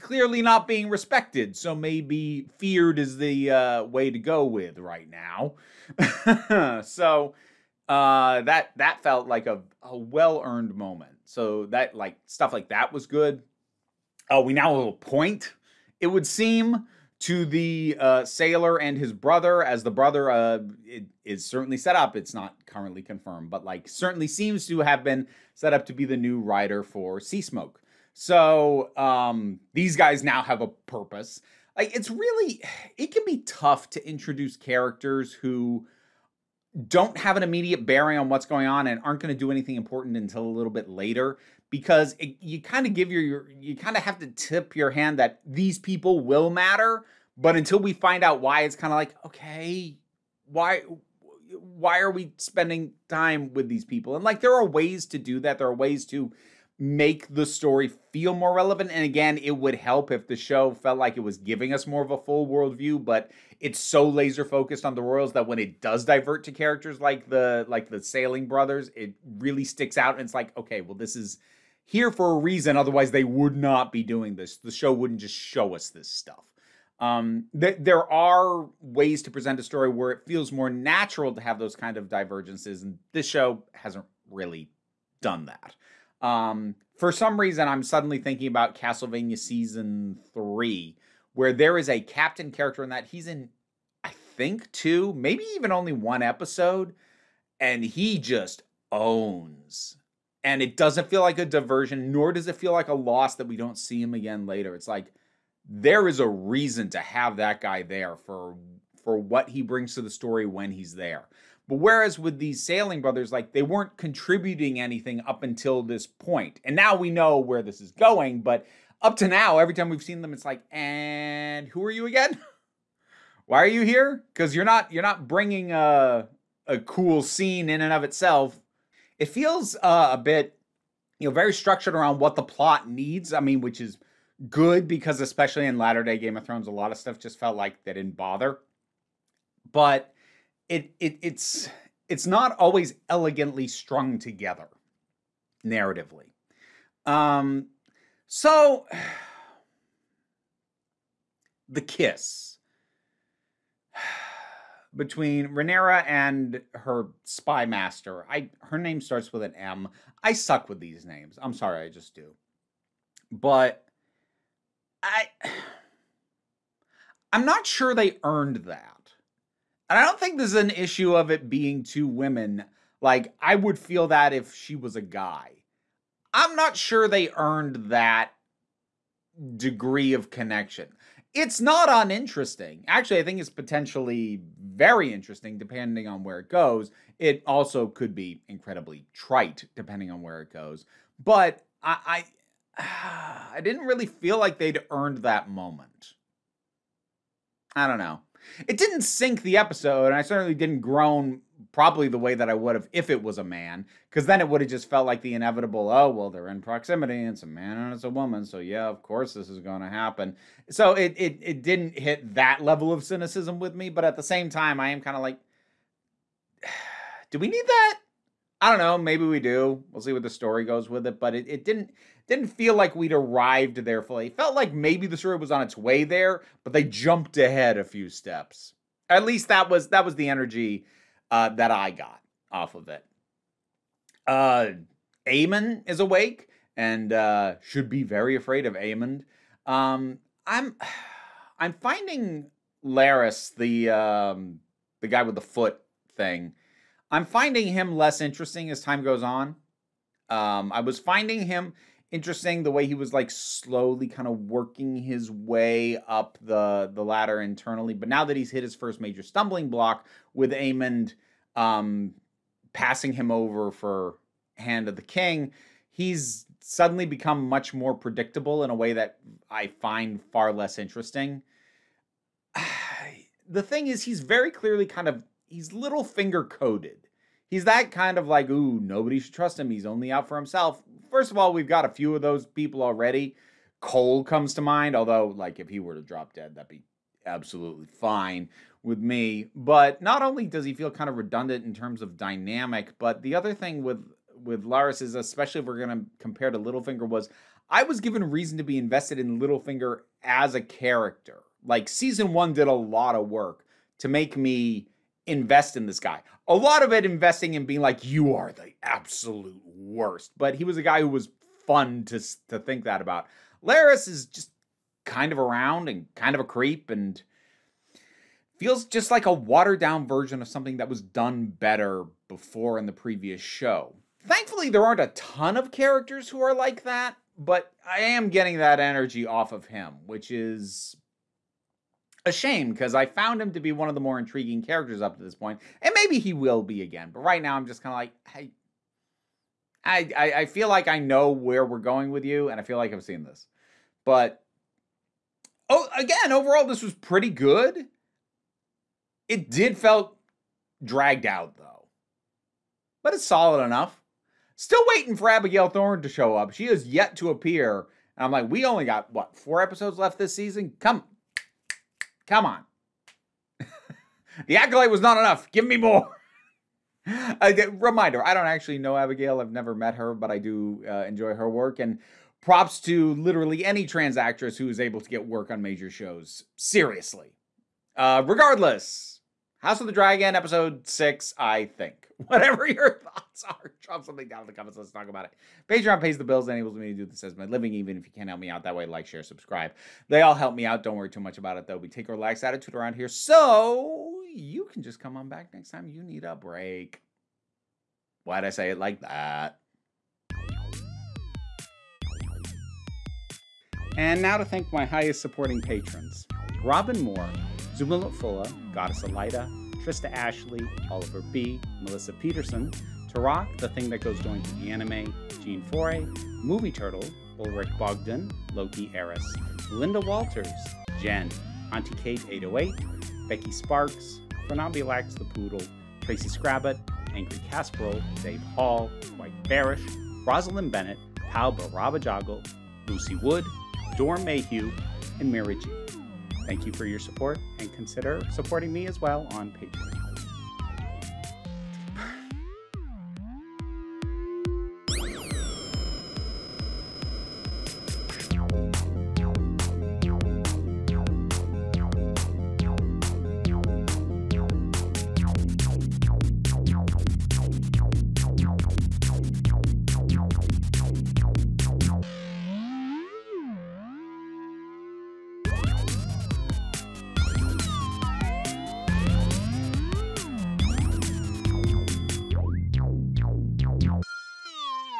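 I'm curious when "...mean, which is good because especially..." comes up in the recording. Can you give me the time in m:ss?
2:13.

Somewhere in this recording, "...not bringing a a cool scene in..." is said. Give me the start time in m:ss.
2:05.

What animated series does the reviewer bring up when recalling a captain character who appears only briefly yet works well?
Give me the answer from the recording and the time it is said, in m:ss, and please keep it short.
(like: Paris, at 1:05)
Castlevania, at 1:28.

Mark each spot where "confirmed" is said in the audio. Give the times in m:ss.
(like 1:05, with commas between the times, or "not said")
0:22.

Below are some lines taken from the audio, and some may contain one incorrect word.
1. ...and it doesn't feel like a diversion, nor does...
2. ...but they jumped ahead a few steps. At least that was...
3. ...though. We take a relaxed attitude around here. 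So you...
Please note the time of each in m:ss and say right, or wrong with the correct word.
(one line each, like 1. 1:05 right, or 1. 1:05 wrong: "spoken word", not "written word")
1. 1:40 right
2. 3:46 right
3. 6:31 right.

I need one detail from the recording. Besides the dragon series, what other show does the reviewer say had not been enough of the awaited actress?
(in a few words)
The Acolyte.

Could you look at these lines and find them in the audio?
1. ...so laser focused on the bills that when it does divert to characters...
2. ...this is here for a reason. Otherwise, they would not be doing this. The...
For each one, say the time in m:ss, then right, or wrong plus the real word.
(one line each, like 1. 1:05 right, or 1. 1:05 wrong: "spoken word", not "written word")
1. 1:03 wrong: "royals", not "bills"
2. 1:10 right.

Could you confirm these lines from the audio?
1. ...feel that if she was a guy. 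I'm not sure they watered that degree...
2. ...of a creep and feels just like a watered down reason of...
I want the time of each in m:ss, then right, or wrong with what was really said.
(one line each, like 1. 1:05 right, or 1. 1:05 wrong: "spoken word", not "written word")
1. 2:53 wrong: "earned", not "watered"
2. 5:16 wrong: "version", not "reason".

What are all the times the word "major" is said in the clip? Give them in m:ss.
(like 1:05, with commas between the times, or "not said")
4:18, 6:15.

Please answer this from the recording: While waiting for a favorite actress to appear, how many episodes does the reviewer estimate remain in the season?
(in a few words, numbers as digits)
4.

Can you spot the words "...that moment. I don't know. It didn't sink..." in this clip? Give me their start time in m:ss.
3:15.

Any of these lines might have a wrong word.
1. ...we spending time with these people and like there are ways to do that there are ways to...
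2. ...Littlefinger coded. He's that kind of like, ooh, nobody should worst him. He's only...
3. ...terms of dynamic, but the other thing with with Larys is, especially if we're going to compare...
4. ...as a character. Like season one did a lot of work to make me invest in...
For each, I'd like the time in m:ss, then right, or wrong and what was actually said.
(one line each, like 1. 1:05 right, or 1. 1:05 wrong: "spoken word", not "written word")
1. 0:52 right
2. 4:35 wrong: "trust", not "worst"
3. 4:51 right
4. 5:00 right.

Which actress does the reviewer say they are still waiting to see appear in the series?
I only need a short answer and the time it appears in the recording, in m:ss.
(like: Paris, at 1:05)
Abigail Thorn, at 5:55.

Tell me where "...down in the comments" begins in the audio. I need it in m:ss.
6:24.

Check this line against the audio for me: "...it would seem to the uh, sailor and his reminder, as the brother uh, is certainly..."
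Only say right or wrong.
wrong.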